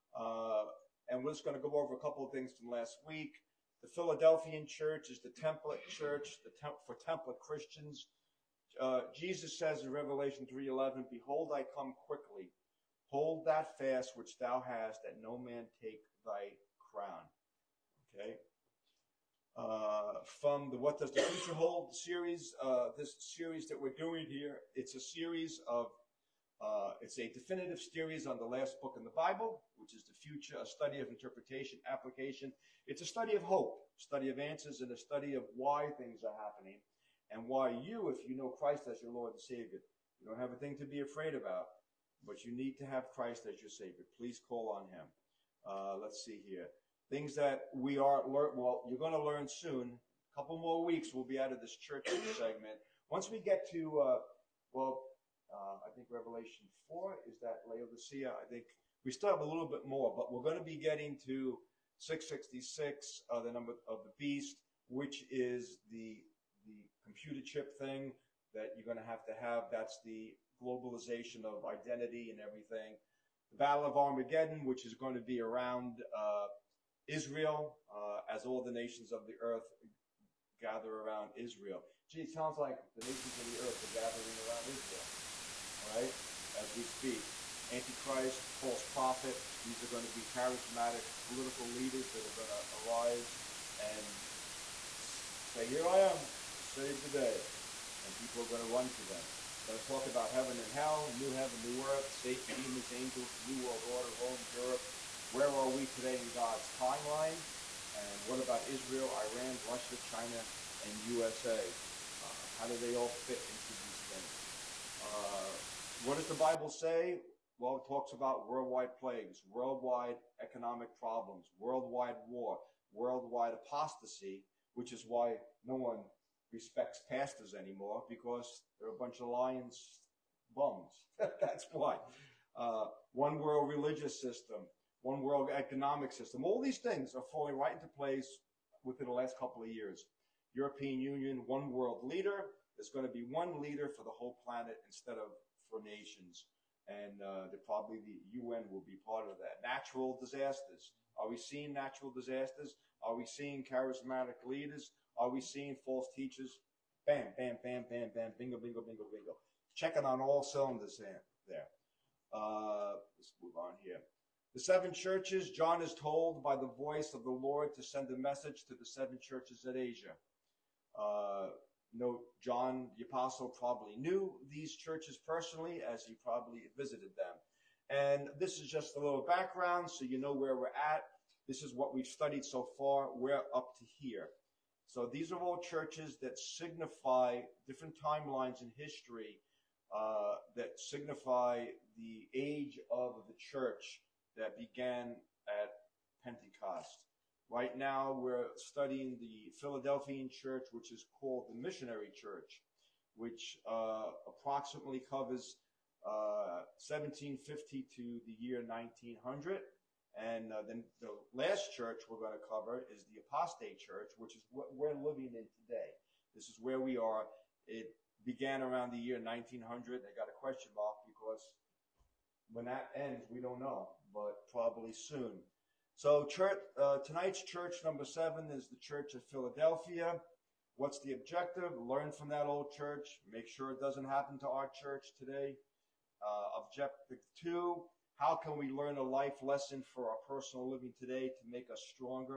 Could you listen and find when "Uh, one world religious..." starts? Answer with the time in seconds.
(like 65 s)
132 s.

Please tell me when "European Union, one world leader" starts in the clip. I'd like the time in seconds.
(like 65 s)
140 s.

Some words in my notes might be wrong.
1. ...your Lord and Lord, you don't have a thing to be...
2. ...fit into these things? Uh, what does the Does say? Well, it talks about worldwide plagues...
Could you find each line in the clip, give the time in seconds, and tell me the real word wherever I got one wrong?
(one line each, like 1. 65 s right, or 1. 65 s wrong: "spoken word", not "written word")
1. 39 s wrong: "Savior", not "Lord"
2. 113 s wrong: "Bible", not "Does".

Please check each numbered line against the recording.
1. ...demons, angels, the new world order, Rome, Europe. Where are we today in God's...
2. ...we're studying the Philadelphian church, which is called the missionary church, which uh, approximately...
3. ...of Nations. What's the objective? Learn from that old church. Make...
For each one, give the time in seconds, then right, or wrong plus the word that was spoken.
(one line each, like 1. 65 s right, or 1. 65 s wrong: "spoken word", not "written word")
1. 102 s right
2. 198 s right
3. 229 s wrong: "Philadelphia", not "Nations".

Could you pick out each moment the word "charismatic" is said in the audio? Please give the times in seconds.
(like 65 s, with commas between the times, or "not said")
90 s, 153 s.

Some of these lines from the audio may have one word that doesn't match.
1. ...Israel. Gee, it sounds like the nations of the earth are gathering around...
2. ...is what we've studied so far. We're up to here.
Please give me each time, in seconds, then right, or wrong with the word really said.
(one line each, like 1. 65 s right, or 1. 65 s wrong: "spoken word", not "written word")
1. 81 s right
2. 181 s right.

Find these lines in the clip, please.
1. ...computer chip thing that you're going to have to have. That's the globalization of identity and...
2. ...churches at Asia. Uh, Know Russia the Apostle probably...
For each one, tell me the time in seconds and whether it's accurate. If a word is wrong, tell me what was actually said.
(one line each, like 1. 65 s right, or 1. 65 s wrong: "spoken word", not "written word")
1. 67 s right
2. 169 s wrong: "John", not "Russia".